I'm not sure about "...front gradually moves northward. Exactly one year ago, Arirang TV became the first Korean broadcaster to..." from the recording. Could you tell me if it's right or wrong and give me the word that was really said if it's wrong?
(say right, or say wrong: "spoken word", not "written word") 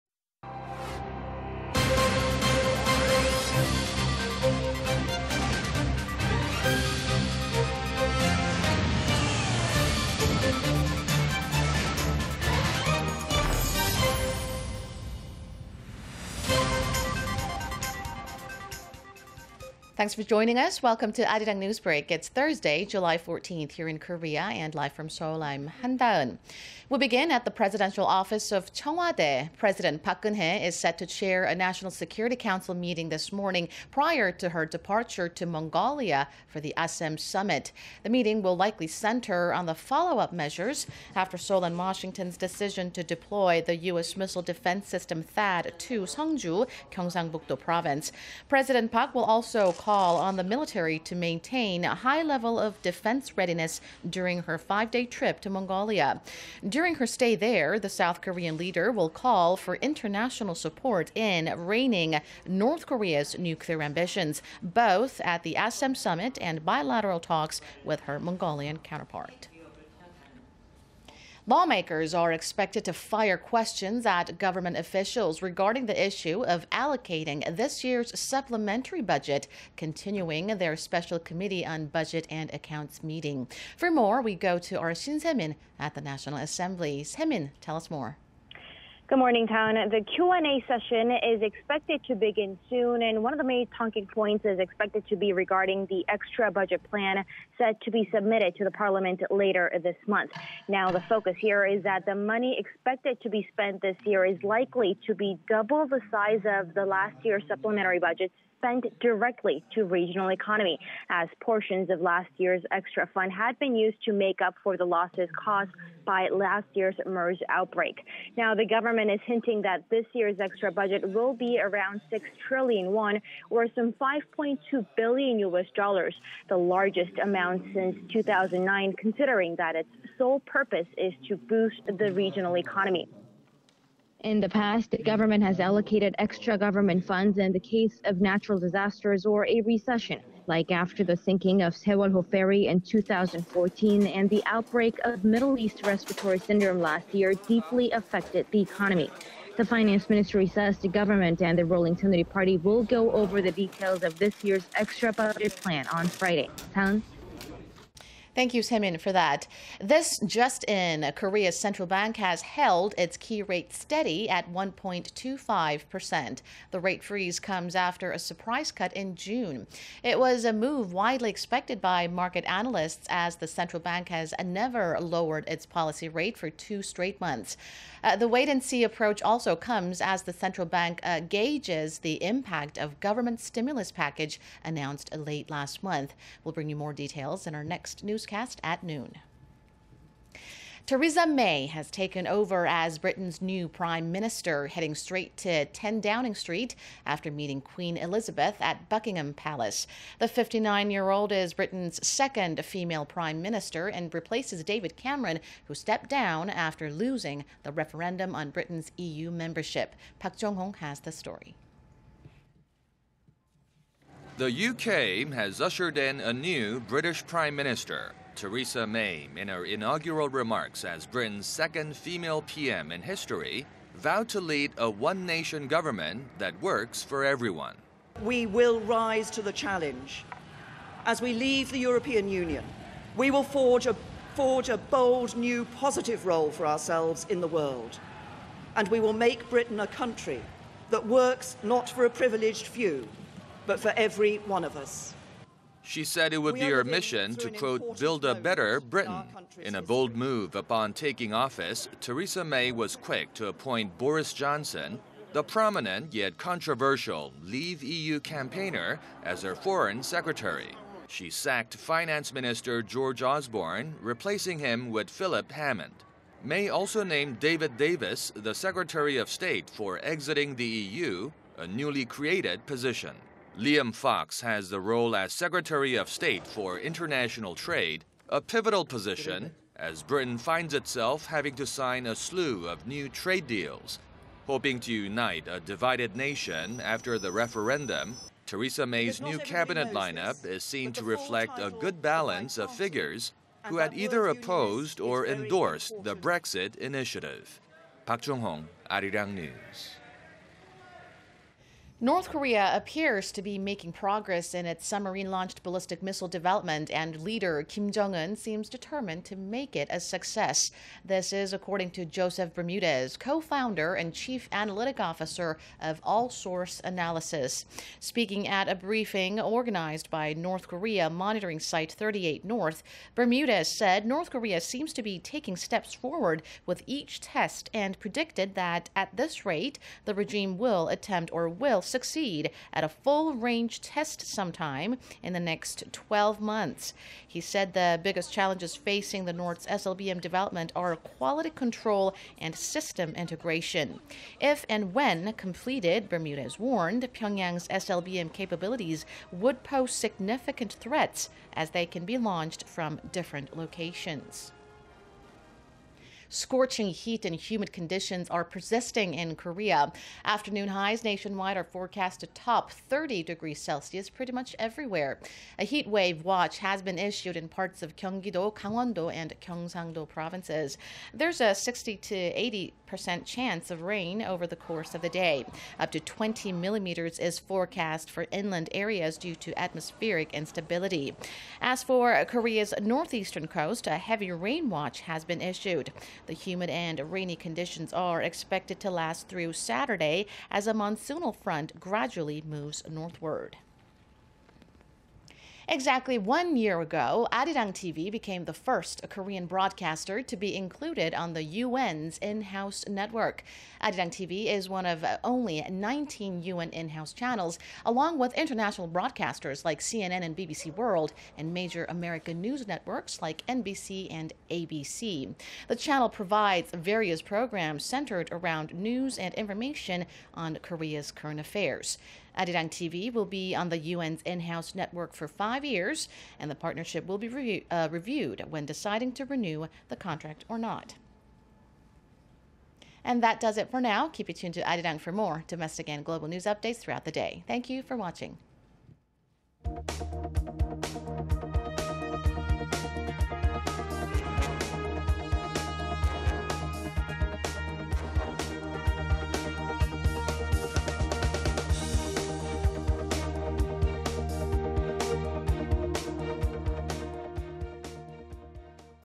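right.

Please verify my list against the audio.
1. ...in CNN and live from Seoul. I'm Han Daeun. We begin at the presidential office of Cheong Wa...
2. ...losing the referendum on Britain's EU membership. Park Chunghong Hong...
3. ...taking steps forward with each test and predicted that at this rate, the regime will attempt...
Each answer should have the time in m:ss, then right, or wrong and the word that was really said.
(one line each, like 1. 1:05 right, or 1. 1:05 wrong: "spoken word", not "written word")
1. 0:23 wrong: "Korea", not "CNN"
2. 3:26 wrong: "Jong", not "Chunghong"
3. 5:25 right.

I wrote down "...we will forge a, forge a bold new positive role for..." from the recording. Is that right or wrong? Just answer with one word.
right.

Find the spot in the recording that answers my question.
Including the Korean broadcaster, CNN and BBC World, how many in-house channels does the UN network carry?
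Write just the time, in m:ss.
6:45.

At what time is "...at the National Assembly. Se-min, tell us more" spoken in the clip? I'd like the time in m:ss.
1:25.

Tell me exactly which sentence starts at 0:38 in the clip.
The meeting will likely center on the follow-up measures after Seoul and Washington's decision to deploy the U.S.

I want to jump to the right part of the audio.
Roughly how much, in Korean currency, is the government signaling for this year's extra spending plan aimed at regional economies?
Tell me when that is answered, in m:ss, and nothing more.
2:02.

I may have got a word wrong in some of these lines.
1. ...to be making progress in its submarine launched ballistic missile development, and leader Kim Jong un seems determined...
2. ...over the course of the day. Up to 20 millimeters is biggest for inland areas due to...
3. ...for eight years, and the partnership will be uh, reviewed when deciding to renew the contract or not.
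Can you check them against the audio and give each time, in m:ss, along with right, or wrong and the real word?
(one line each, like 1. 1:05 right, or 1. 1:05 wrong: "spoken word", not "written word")
1. 5:03 right
2. 6:14 wrong: "forecast", not "biggest"
3. 7:05 wrong: "five", not "eight".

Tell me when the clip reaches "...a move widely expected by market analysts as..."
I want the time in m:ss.
2:50.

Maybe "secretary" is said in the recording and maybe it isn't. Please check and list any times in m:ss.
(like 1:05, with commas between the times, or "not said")
4:20, 4:28, 4:35.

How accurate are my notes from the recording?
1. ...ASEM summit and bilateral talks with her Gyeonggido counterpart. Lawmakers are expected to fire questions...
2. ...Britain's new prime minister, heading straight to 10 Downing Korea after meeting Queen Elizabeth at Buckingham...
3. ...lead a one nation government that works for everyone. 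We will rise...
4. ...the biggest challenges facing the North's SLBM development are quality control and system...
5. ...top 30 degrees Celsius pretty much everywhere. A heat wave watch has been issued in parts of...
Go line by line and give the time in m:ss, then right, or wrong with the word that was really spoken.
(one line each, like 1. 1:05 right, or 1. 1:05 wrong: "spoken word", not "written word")
1. 1:05 wrong: "Mongolian", not "Gyeonggido"
2. 3:12 wrong: "Street", not "Korea"
3. 3:44 right
4. 5:37 right
5. 6:02 right.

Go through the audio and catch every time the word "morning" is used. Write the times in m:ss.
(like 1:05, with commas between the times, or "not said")
0:33, 1:29.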